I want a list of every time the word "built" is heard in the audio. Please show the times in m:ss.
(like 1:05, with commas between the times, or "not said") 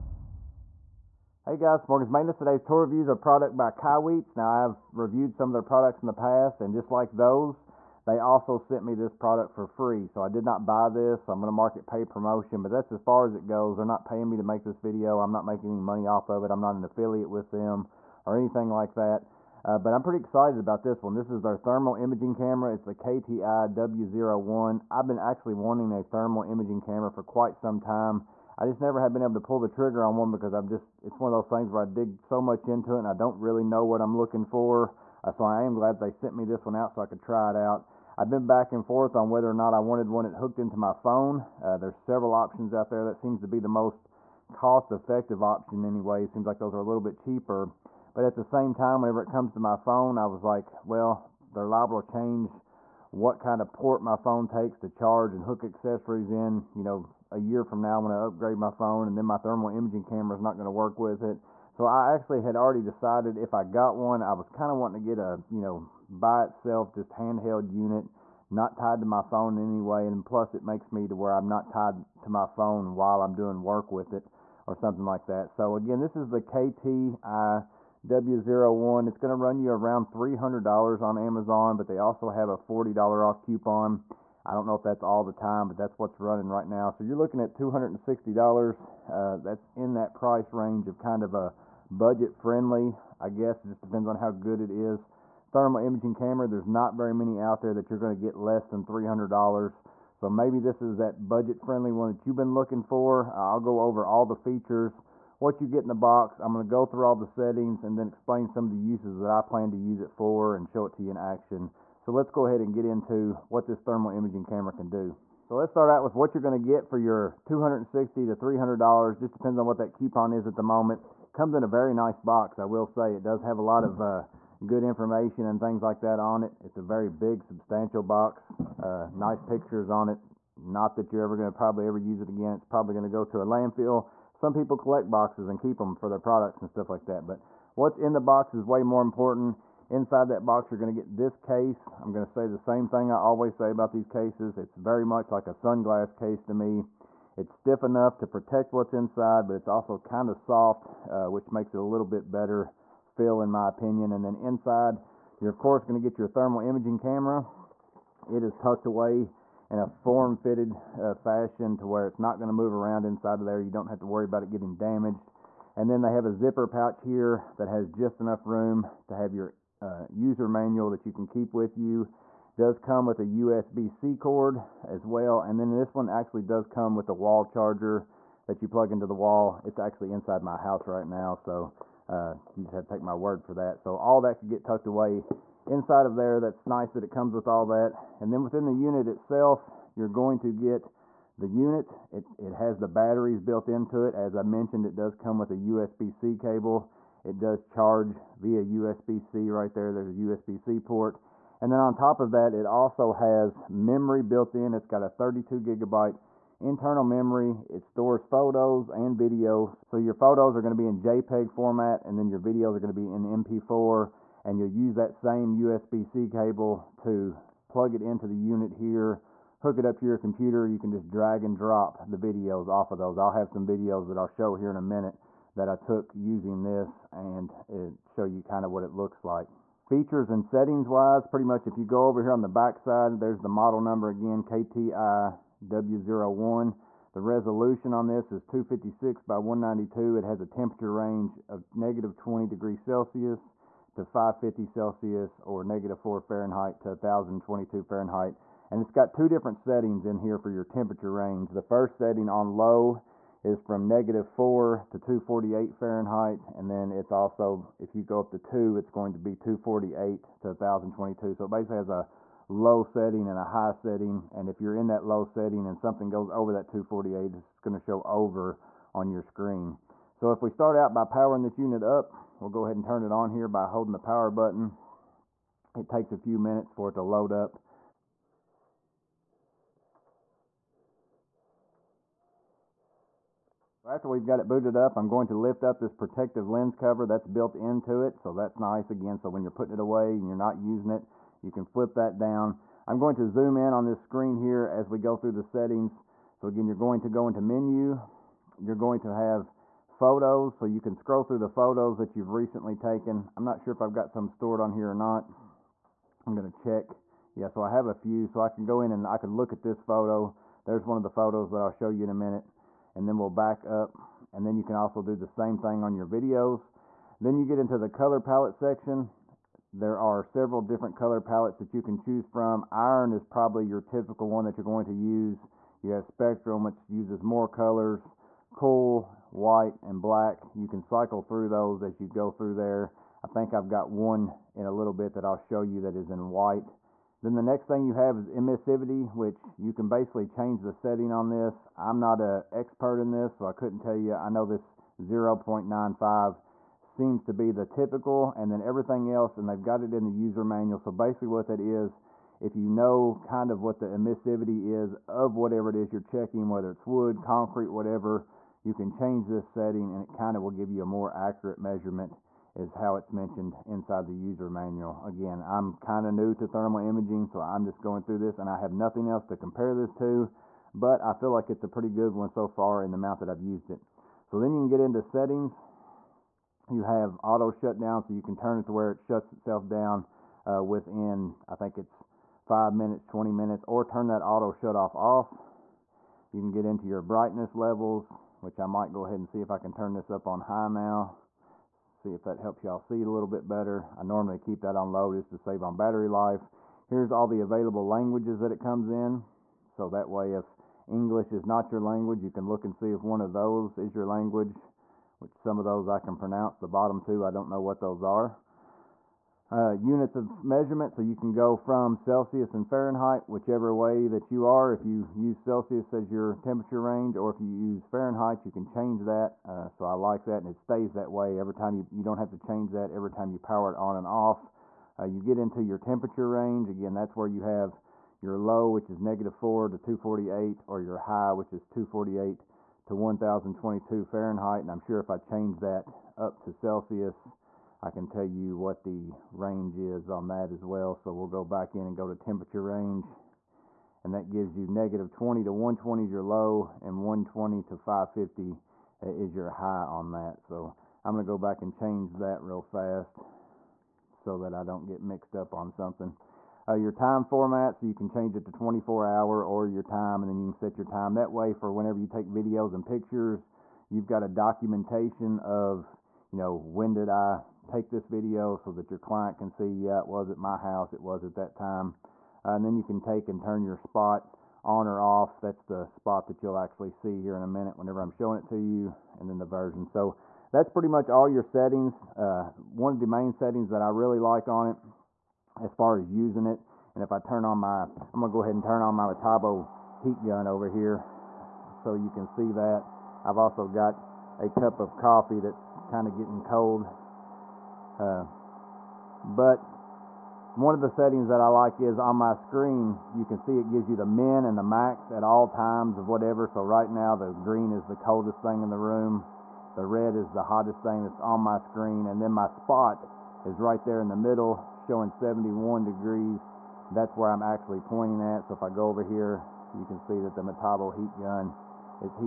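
3:13, 3:24, 4:47.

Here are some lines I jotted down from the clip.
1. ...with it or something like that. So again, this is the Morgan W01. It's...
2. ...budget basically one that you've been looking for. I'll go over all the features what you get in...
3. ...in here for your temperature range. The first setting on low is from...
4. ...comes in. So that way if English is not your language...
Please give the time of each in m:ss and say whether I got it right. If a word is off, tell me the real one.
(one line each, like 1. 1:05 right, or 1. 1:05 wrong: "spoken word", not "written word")
1. 1:13 wrong: "KTI", not "Morgan"
2. 1:41 wrong: "friendly", not "basically"
3. 4:10 right
4. 6:38 right.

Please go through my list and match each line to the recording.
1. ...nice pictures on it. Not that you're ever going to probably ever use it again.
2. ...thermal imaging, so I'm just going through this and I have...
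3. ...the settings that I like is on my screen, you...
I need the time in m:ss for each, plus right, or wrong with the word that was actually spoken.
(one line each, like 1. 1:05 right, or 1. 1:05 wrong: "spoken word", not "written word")
1. 2:09 right
2. 6:06 right
3. 8:20 right.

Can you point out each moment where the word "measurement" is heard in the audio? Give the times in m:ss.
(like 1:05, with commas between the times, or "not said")
6:01, 6:50.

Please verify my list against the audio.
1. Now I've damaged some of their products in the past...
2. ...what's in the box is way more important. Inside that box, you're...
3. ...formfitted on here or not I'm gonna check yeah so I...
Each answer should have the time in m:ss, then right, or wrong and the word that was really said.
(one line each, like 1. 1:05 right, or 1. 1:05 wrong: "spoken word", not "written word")
1. 0:04 wrong: "reviewed", not "damaged"
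2. 2:17 right
3. 5:04 wrong: "stored", not "formfitted".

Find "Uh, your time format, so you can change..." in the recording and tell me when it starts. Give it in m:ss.
7:36.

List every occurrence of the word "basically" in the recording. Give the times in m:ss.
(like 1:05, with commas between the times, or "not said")
4:21, 5:39, 5:50.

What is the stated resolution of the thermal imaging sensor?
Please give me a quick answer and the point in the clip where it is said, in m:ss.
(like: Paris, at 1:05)
256 by 192, at 3:58.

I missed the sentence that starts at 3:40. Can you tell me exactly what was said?
You can just drag and drop the videos off of those.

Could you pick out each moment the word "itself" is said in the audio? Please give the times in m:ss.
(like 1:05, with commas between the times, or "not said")
1:06, 3:09, 6:19.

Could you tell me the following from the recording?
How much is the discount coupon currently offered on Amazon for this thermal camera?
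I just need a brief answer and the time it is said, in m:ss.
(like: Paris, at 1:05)
$40, at 1:22.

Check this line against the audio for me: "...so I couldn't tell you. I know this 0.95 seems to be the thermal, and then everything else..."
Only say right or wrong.
wrong.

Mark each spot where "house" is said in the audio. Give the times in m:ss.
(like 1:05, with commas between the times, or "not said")
3:00, 7:50.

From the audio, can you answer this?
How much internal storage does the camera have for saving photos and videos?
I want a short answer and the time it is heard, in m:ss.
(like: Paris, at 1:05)
32 gigabytes, at 3:25.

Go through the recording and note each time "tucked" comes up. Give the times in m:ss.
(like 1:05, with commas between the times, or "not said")
2:38, 3:04.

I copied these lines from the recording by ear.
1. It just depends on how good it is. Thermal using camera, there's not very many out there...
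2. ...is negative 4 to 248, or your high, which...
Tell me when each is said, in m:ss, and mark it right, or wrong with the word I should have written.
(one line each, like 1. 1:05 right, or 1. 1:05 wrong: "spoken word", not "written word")
1. 1:33 wrong: "imaging", not "using"
2. 7:08 right.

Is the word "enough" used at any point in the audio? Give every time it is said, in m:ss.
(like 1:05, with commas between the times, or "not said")
2:27, 2:48.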